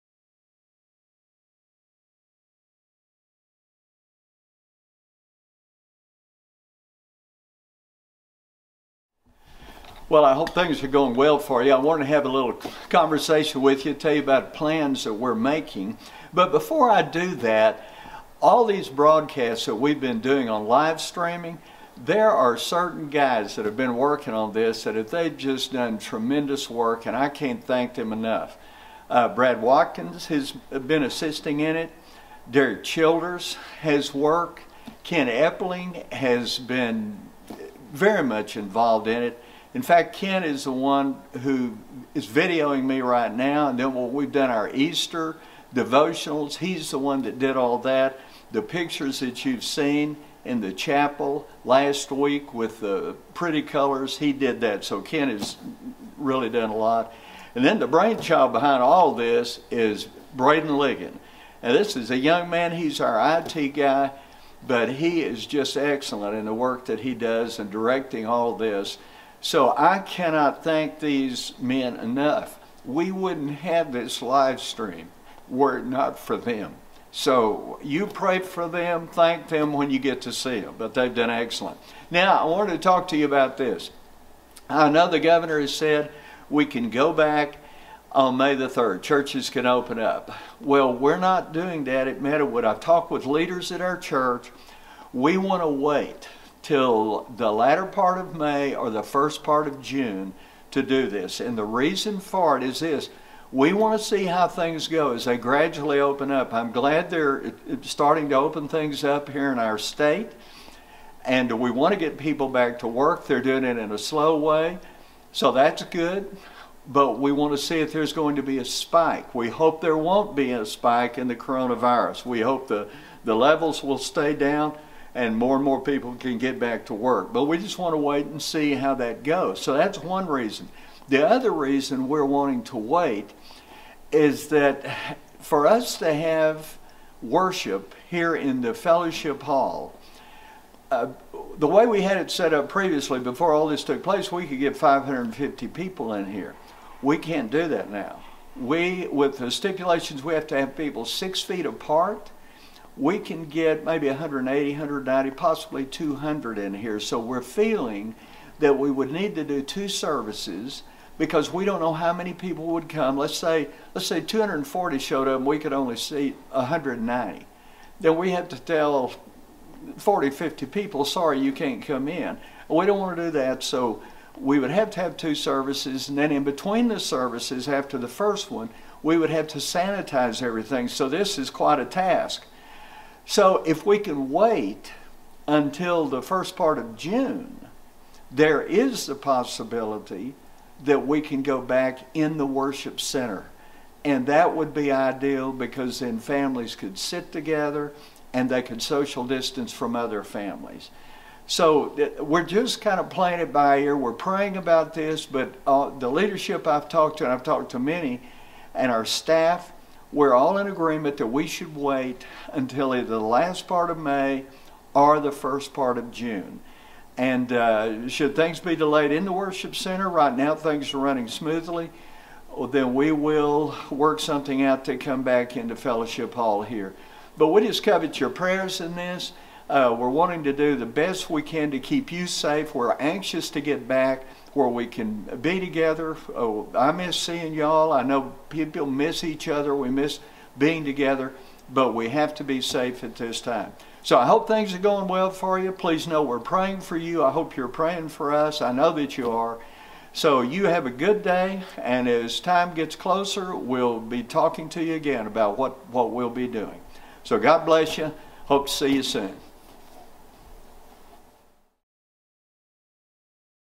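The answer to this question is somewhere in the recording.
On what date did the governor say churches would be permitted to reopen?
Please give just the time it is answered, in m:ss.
1:28.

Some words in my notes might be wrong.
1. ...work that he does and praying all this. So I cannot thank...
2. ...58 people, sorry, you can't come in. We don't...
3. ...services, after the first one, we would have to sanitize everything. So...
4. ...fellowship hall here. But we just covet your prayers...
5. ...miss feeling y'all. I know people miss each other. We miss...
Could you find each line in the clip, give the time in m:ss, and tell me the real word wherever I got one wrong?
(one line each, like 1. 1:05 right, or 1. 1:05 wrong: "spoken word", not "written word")
1. 1:06 wrong: "directing", not "praying"
2. 2:50 wrong: "50", not "58"
3. 2:56 right
4. 3:45 right
5. 3:56 wrong: "seeing", not "feeling".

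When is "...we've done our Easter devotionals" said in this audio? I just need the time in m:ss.
0:44.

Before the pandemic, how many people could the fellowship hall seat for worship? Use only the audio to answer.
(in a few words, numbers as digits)
550.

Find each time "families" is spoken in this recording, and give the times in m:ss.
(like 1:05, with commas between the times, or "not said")
3:16, 3:20.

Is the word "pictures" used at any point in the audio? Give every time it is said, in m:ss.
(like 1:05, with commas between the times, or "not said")
0:48.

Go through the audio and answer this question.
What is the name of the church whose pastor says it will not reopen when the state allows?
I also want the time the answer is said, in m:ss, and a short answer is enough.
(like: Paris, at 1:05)
Meadowood, at 1:32.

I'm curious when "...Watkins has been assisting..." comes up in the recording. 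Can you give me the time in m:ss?
0:29.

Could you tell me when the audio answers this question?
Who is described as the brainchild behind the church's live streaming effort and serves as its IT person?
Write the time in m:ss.
1:00.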